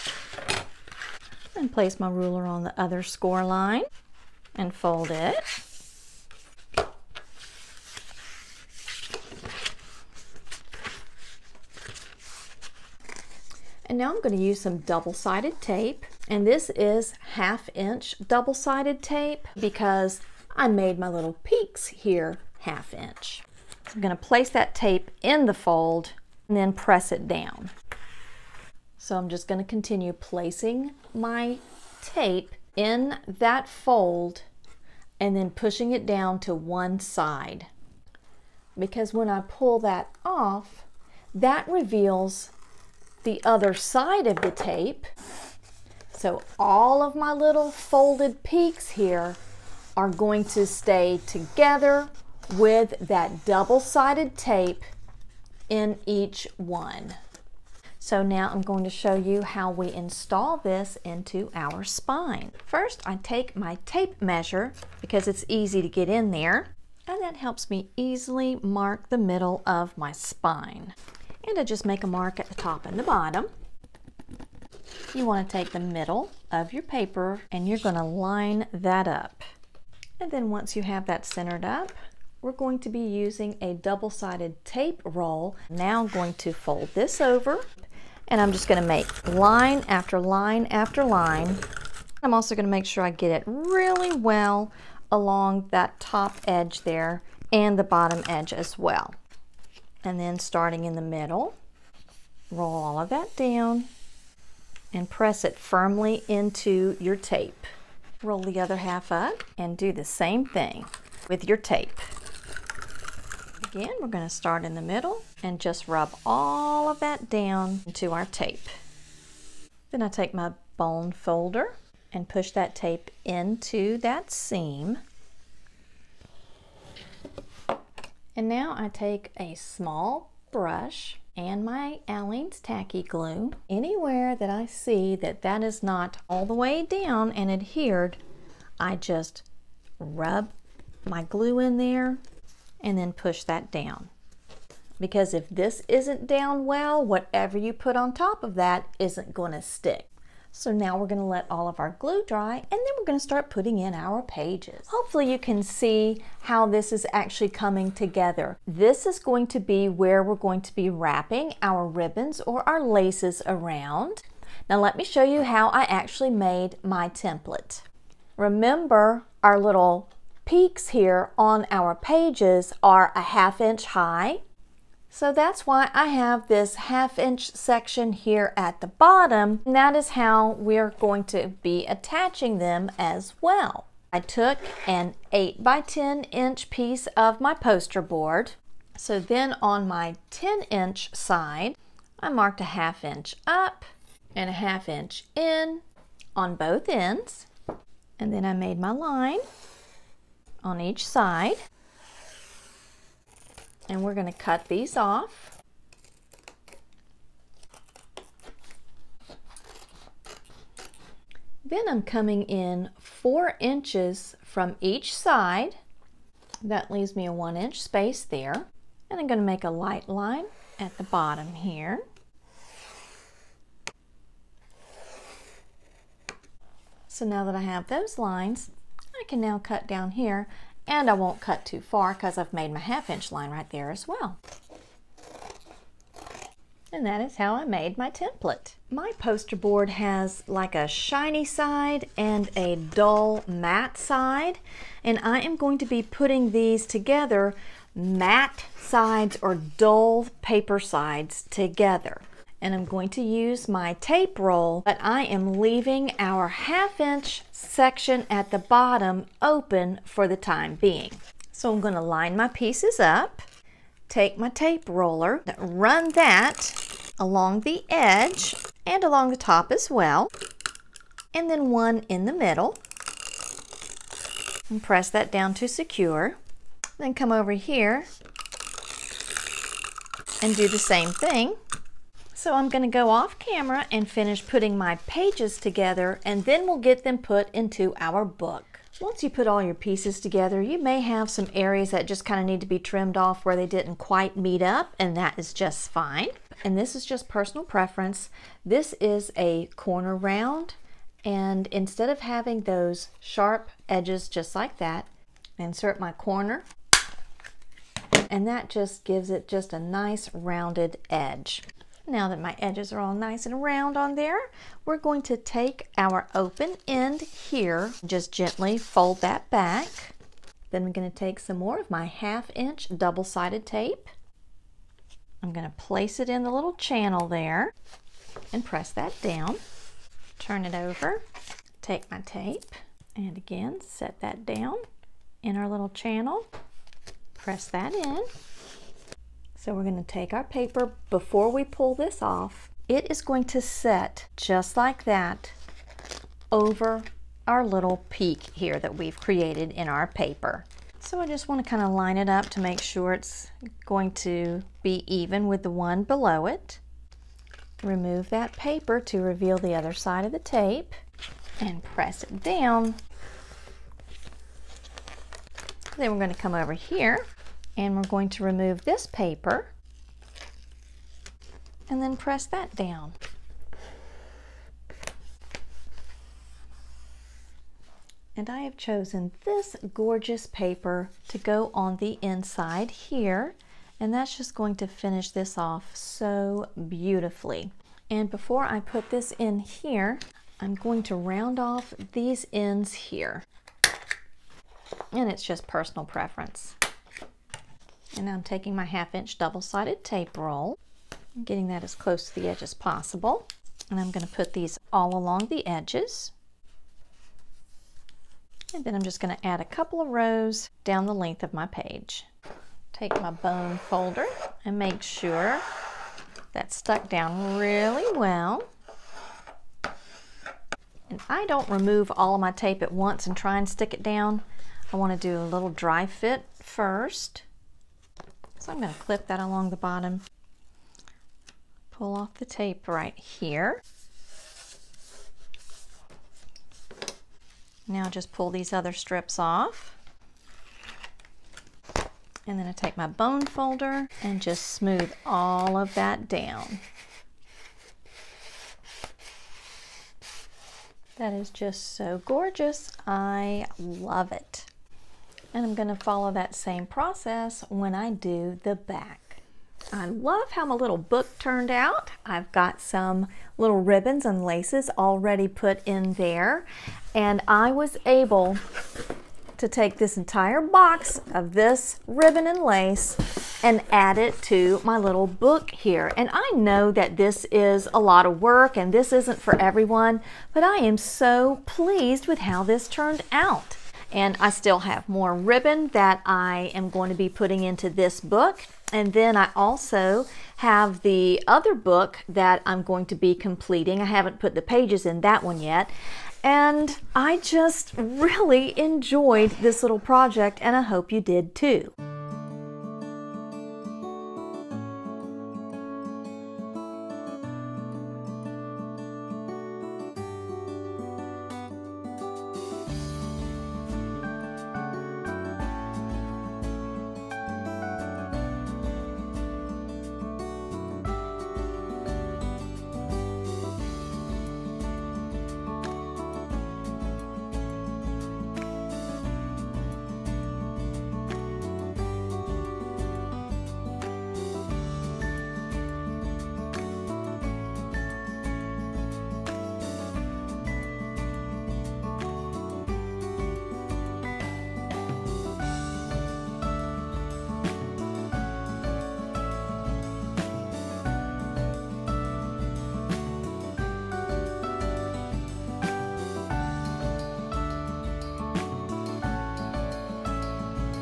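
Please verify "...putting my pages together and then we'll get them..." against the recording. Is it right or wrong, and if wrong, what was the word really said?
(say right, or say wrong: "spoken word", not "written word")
right.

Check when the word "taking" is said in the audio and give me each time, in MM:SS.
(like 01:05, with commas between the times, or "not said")
06:38.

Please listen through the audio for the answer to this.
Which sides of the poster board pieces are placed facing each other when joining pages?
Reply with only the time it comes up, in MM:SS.
04:07.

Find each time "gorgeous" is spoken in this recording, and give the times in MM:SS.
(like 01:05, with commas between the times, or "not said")
06:19, 07:32.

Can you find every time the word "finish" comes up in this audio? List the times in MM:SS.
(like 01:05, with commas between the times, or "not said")
04:44, 06:24.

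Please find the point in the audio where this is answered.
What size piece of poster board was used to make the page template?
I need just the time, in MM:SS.
03:05.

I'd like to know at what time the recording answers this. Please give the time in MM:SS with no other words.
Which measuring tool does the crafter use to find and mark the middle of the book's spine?
01:03.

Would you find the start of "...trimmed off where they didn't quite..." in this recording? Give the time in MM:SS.
04:52.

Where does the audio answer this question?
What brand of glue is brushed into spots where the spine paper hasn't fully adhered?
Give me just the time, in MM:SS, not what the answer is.
02:12.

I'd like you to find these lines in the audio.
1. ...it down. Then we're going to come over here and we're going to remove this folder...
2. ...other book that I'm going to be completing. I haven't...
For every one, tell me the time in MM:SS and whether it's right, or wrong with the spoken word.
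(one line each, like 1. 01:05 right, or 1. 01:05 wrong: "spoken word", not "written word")
1. 06:02 wrong: "paper", not "folder"
2. 08:11 right.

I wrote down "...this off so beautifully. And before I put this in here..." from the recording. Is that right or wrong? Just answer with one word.
right.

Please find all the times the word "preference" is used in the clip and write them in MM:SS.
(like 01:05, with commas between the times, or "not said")
04:57, 06:36.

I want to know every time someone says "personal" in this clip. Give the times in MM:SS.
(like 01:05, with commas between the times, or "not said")
04:57, 06:35.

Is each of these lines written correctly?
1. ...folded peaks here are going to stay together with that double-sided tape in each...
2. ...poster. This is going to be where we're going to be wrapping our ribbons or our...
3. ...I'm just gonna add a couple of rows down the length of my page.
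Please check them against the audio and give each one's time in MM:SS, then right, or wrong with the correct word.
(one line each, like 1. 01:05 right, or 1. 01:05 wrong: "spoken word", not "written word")
1. 00:47 right
2. 02:37 wrong: "together", not "poster"
3. 06:48 right.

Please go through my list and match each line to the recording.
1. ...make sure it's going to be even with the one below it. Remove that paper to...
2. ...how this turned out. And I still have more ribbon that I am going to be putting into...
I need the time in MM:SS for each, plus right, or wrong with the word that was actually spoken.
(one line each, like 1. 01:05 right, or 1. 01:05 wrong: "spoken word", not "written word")
1. 05:52 right
2. 08:02 right.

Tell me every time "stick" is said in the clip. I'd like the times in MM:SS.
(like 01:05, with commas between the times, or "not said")
02:29, 07:03.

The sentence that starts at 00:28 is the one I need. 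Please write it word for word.
So I'm just going to continue placing my tape in that fold and then pushing it down to one side.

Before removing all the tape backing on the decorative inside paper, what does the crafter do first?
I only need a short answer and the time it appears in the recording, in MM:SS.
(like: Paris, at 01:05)
dry fit, at 07:05.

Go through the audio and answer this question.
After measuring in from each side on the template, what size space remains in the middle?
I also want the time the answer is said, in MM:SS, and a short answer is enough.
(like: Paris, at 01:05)
1 inch, at 03:37.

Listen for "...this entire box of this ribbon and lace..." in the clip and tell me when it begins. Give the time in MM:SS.
07:49.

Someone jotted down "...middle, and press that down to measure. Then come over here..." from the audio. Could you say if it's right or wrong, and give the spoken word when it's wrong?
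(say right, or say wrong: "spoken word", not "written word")
wrong: "secure", not "measure".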